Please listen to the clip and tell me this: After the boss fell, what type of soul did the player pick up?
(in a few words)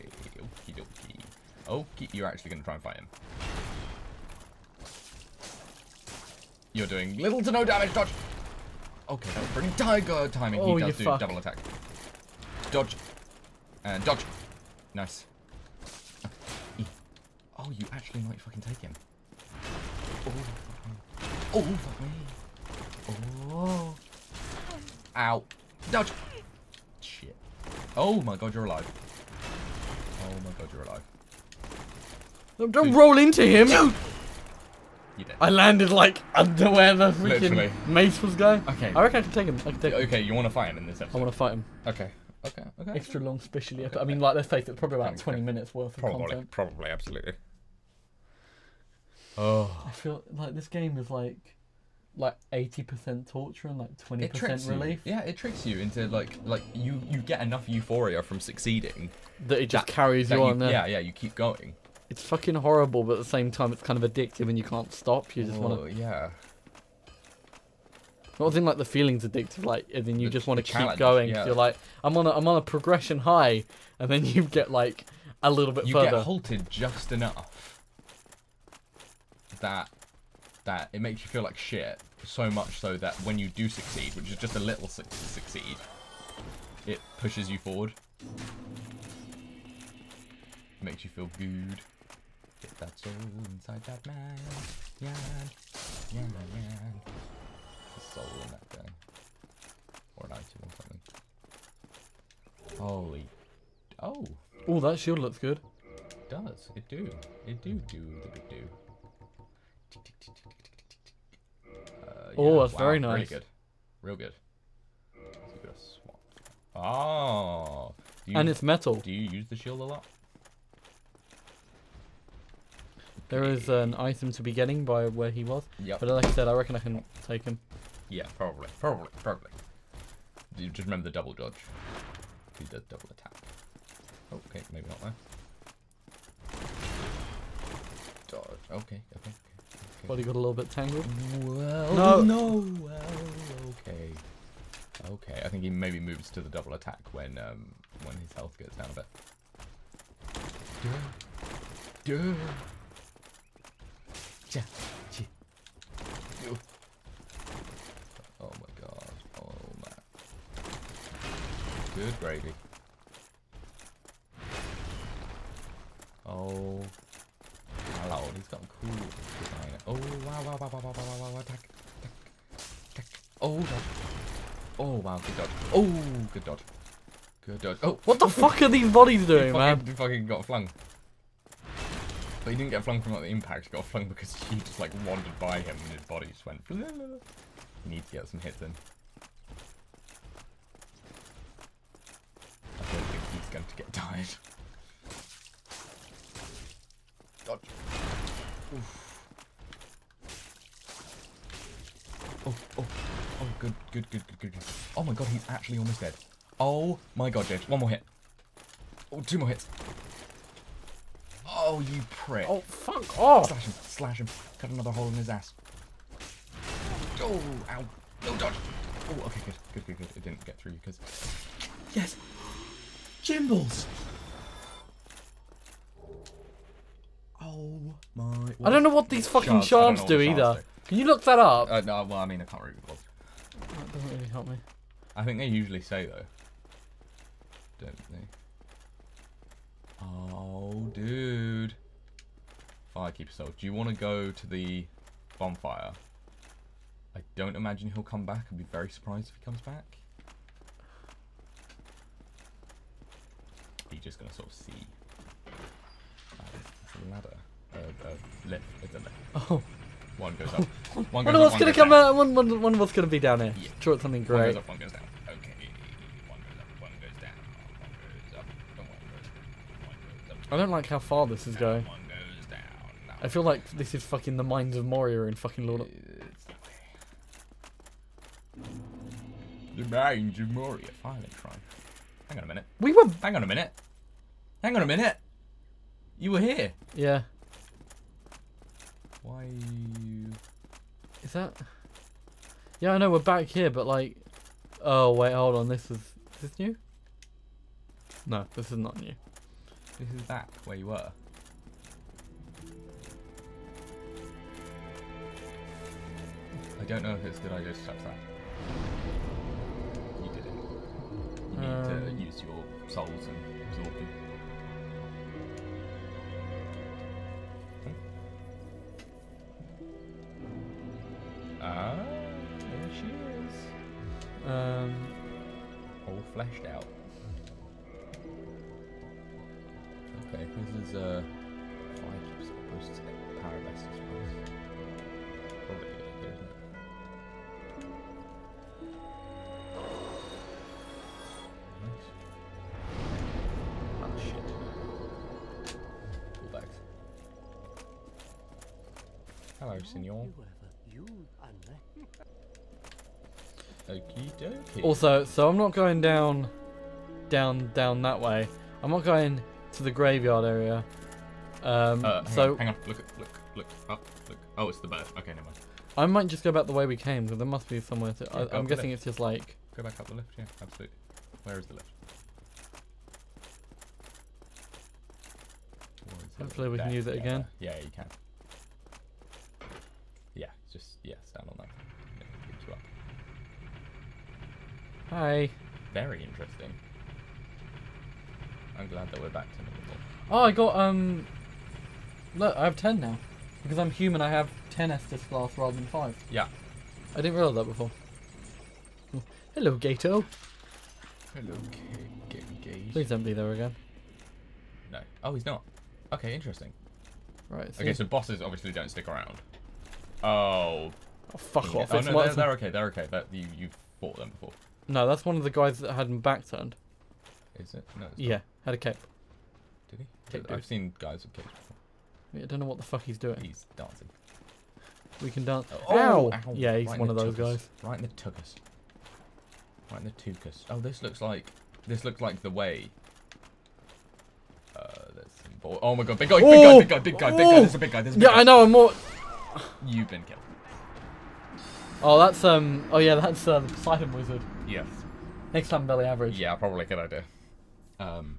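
Firekeeper soul.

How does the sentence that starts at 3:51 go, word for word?
Uh, no, well, I mean, I can't read really doesn't really help me.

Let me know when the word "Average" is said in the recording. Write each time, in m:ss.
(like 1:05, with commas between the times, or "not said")
7:26.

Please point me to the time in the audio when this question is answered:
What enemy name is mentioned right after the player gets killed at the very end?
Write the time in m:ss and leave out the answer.
7:23.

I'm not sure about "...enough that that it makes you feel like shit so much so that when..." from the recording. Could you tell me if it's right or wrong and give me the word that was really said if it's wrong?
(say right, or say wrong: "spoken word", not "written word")
right.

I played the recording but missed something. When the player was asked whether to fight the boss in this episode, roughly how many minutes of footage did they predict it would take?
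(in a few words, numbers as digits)
20 minutes.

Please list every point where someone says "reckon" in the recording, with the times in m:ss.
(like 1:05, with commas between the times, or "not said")
0:39, 2:06.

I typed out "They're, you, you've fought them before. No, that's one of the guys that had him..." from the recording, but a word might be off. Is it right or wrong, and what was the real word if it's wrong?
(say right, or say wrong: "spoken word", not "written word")
right.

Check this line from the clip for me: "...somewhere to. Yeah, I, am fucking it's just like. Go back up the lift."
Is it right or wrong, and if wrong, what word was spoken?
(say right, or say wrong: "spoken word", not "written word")
wrong: "guessing", not "fucking".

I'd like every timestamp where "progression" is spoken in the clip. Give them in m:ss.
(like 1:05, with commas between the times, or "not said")
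1:12.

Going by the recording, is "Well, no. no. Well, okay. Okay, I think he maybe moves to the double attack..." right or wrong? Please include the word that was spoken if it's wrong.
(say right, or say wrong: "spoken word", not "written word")
right.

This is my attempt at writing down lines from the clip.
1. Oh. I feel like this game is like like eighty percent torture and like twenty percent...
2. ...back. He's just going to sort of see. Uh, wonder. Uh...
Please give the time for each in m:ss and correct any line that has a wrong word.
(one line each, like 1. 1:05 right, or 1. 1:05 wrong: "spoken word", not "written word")
1. 0:49 right
2. 4:09 wrong: "ladder", not "wonder".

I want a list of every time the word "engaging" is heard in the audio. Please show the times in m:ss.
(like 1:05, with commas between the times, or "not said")
not said.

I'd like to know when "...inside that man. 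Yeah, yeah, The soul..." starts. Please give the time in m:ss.
1:33.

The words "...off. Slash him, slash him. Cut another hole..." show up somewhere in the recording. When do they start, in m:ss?
3:33.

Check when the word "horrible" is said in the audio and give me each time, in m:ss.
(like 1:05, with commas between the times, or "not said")
1:02.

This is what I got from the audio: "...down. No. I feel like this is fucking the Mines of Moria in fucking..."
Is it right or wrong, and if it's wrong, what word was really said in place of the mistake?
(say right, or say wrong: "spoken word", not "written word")
right.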